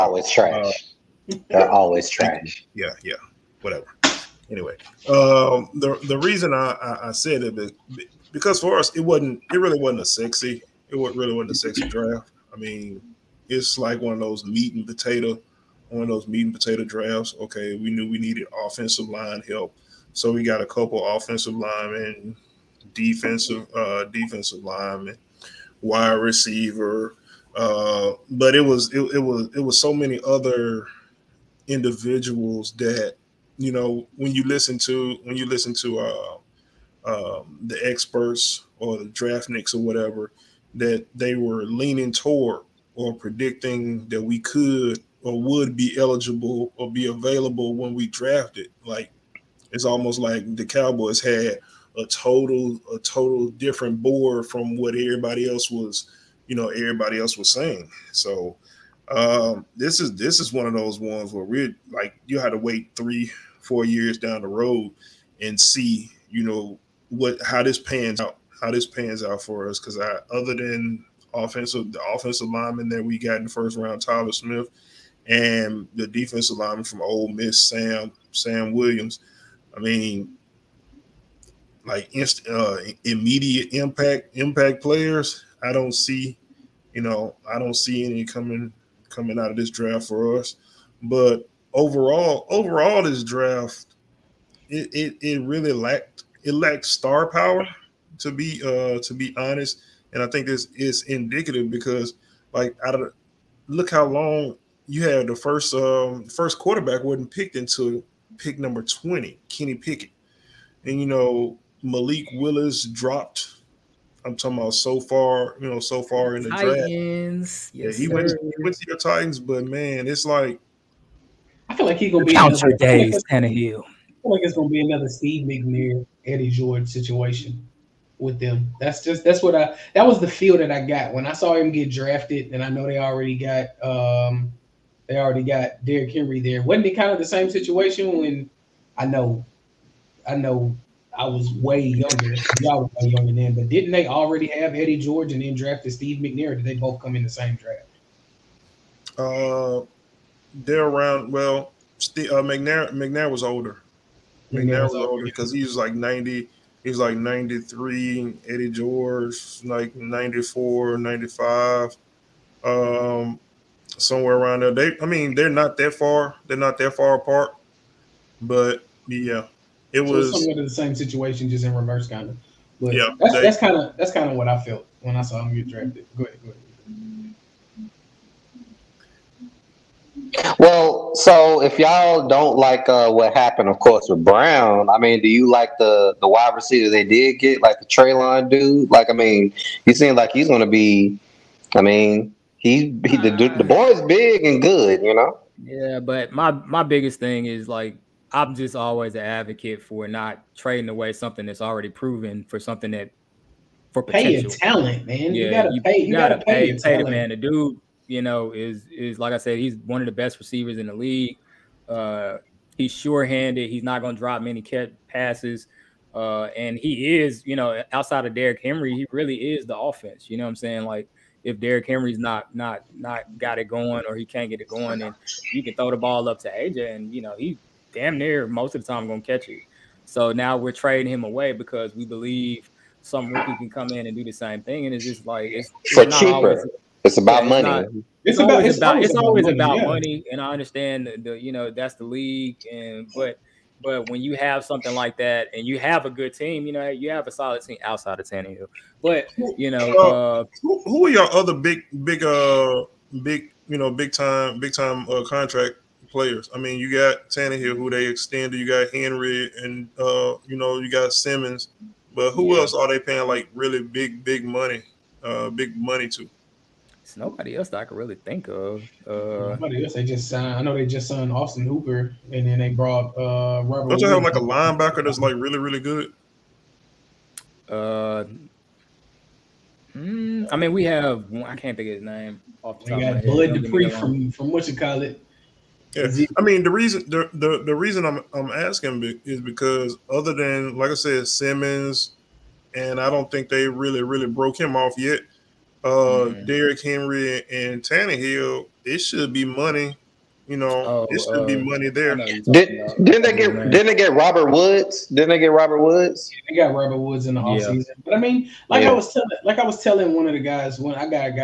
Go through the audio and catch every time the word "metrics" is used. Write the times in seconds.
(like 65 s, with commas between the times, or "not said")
not said.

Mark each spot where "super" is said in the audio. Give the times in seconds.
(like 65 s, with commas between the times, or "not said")
not said.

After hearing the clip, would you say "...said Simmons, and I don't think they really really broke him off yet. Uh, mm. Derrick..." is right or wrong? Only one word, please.
right.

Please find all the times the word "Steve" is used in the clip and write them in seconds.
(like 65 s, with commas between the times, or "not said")
125 s, 145 s, 151 s.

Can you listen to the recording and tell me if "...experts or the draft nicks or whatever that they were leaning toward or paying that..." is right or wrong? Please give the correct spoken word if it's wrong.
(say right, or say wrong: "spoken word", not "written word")
wrong: "predicting", not "paying".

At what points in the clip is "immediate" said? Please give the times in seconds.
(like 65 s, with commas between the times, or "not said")
83 s.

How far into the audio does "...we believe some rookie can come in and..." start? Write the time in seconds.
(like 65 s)
231 s.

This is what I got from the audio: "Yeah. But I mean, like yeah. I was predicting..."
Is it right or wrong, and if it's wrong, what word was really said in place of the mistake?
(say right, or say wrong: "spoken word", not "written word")
wrong: "telling", not "predicting".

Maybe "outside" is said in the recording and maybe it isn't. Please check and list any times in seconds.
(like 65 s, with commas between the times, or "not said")
217 s, 247 s.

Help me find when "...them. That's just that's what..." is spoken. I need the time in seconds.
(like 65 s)
128 s.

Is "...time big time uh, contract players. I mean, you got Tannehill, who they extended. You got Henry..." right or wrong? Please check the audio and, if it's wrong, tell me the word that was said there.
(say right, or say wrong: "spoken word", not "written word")
right.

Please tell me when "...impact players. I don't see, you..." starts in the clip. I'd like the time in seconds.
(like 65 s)
84 s.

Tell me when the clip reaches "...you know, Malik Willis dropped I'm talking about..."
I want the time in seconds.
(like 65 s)
110 s.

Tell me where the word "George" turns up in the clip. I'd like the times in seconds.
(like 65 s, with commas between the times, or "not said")
126 s, 144 s, 158 s.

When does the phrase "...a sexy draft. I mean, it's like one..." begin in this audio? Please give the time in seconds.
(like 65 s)
11 s.